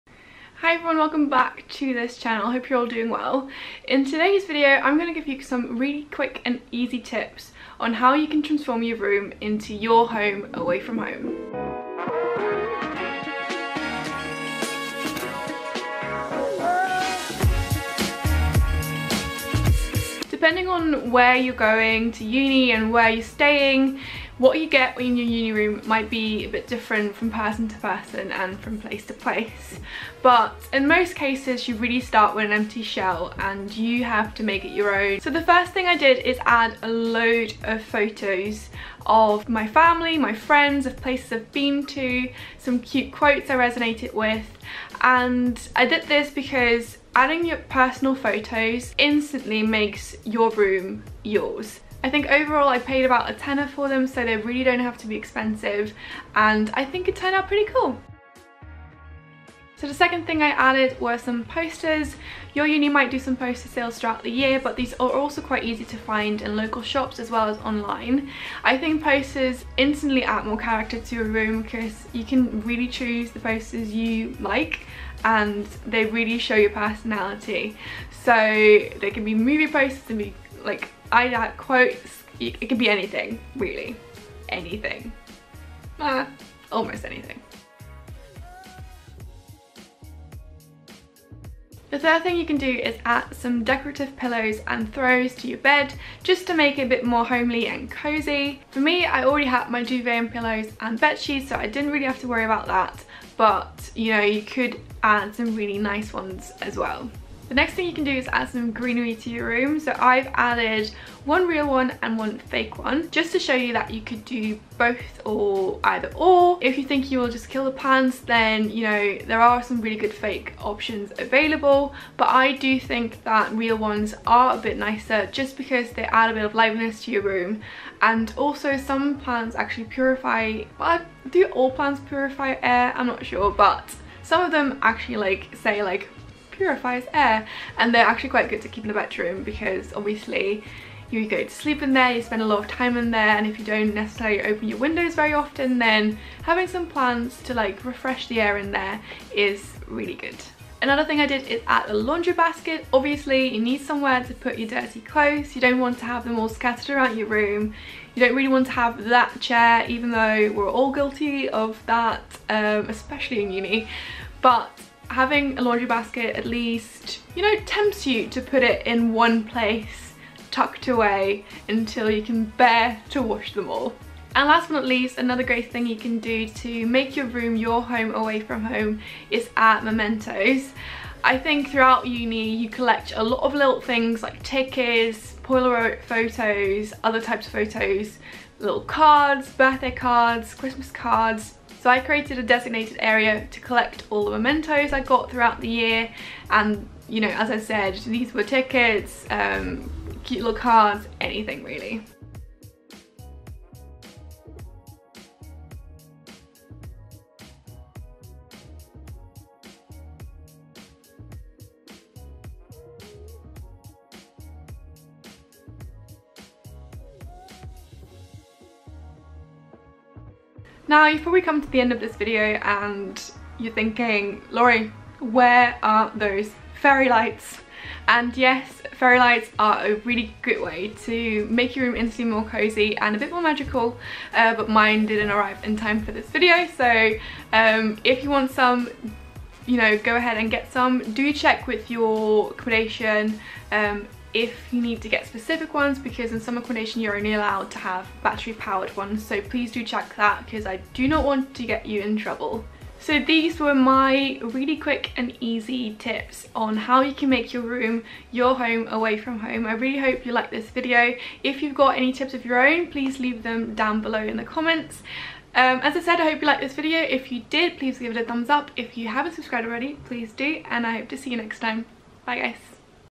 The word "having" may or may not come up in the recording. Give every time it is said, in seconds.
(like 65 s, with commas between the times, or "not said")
146 s, 165 s.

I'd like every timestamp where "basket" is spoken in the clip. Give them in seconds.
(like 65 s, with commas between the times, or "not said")
152 s, 165 s.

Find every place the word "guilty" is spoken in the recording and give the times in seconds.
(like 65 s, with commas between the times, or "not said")
160 s.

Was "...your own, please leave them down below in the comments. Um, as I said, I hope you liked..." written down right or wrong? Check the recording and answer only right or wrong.
right.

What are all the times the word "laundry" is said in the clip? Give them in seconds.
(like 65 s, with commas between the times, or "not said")
151 s, 165 s.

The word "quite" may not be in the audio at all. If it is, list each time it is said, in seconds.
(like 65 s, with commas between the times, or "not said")
65 s, 138 s.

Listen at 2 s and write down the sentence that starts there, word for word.
I hope you're all doing well.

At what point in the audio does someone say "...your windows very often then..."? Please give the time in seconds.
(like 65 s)
144 s.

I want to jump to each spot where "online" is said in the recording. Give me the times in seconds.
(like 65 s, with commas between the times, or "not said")
67 s.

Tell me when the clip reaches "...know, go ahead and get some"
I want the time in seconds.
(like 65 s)
239 s.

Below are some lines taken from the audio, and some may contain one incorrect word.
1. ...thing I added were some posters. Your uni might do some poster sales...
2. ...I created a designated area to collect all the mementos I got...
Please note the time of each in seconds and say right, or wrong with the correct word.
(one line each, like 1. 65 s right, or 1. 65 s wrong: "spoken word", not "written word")
1. 60 s right
2. 191 s right.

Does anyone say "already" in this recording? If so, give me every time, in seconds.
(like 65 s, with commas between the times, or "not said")
99 s, 269 s.